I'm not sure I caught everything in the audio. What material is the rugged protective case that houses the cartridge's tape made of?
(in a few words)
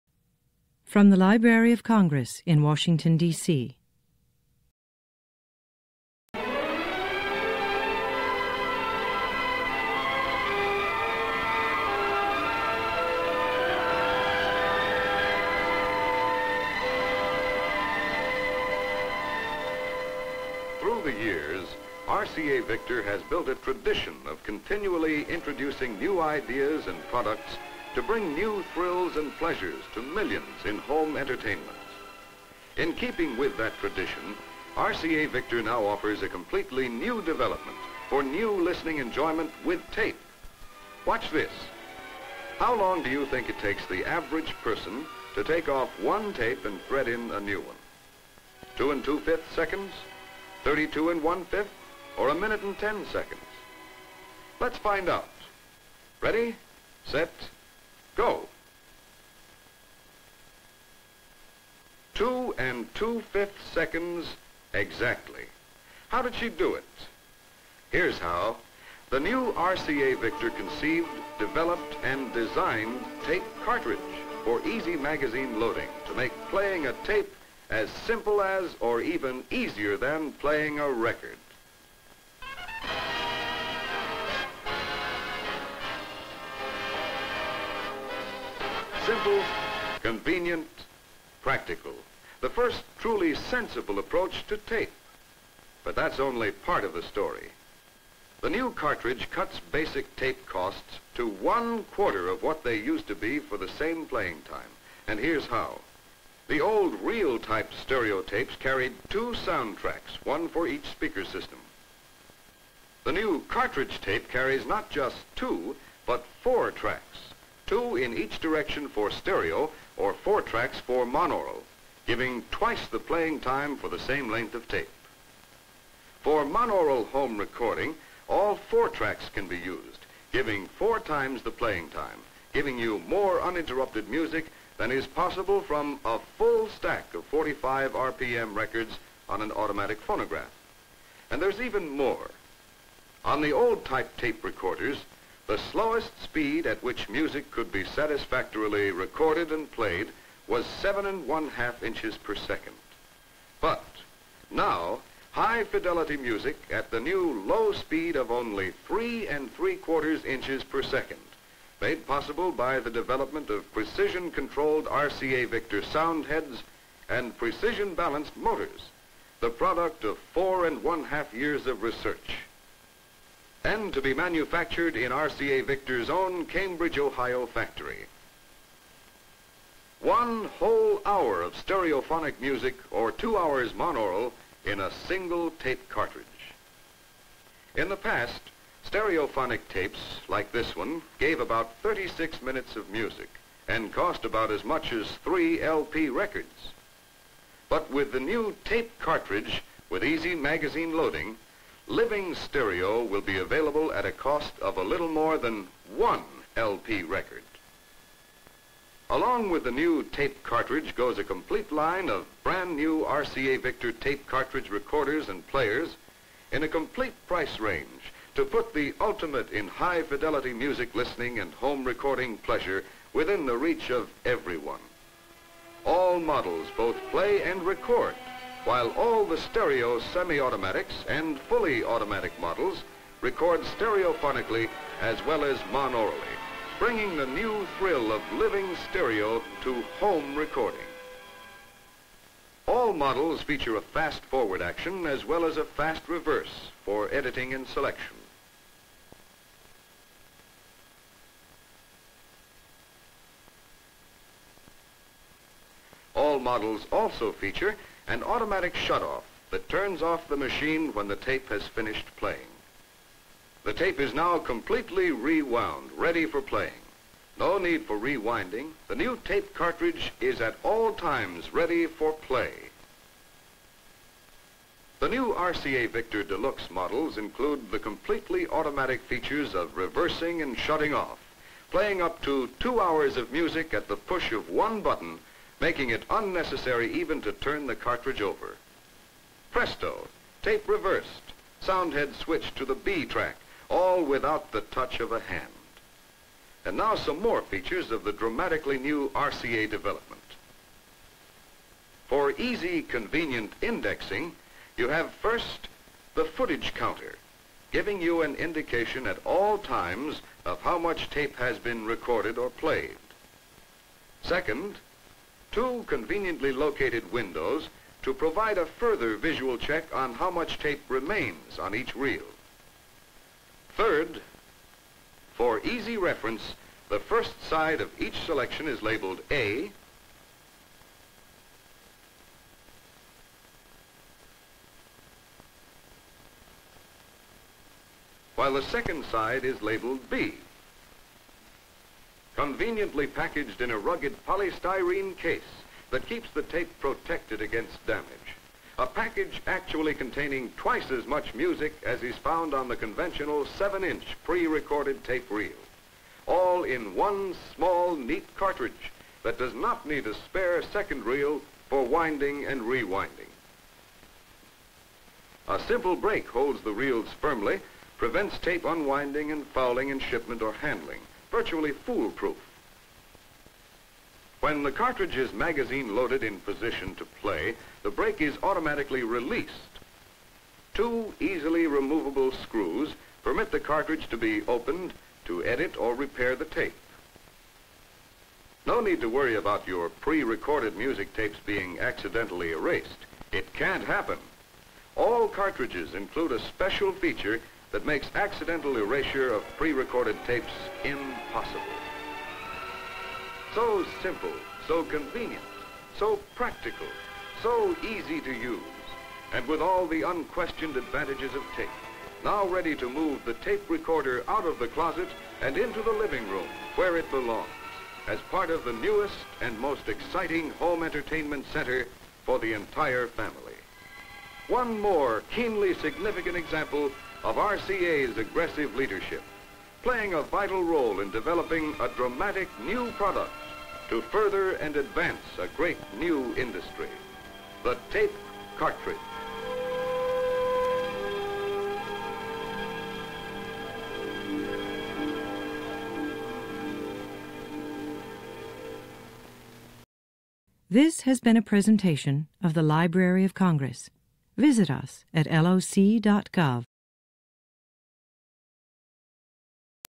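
polystyrene.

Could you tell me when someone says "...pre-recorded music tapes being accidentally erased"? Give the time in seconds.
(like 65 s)
389 s.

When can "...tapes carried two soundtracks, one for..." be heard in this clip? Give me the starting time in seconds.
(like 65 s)
108 s.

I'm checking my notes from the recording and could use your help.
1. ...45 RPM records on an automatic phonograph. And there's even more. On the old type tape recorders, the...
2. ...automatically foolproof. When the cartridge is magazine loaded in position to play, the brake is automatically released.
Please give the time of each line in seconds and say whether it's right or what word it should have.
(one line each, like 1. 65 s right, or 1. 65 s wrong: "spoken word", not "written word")
1. 137 s right
2. 371 s wrong: "virtually", not "automatically".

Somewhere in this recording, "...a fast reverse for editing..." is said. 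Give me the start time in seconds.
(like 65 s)
245 s.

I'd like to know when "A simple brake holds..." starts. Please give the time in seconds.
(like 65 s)
365 s.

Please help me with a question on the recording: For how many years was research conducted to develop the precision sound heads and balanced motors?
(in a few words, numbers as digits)
4 1/2.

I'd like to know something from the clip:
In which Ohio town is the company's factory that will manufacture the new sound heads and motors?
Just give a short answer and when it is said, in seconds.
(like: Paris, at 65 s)
Cambridge, at 176 s.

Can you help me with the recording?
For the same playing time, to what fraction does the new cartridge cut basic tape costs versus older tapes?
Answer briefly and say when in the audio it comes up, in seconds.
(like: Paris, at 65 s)
one quarter, at 101 s.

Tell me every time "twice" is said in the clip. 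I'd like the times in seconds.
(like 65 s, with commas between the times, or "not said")
122 s, 350 s.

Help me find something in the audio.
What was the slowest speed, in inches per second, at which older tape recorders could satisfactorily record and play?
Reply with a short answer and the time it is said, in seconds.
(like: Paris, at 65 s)
7 1/2, at 150 s.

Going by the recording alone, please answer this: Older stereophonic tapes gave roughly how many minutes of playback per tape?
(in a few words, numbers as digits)
36 minutes.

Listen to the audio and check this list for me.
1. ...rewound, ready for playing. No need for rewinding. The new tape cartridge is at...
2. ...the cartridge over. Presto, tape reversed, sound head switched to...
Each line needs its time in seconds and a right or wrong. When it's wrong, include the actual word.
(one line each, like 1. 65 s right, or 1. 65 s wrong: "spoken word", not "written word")
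1. 265 s right
2. 287 s right.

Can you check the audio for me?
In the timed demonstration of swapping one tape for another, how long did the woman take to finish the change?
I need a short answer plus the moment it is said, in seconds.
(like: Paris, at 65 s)
2 2/5 seconds, at 62 s.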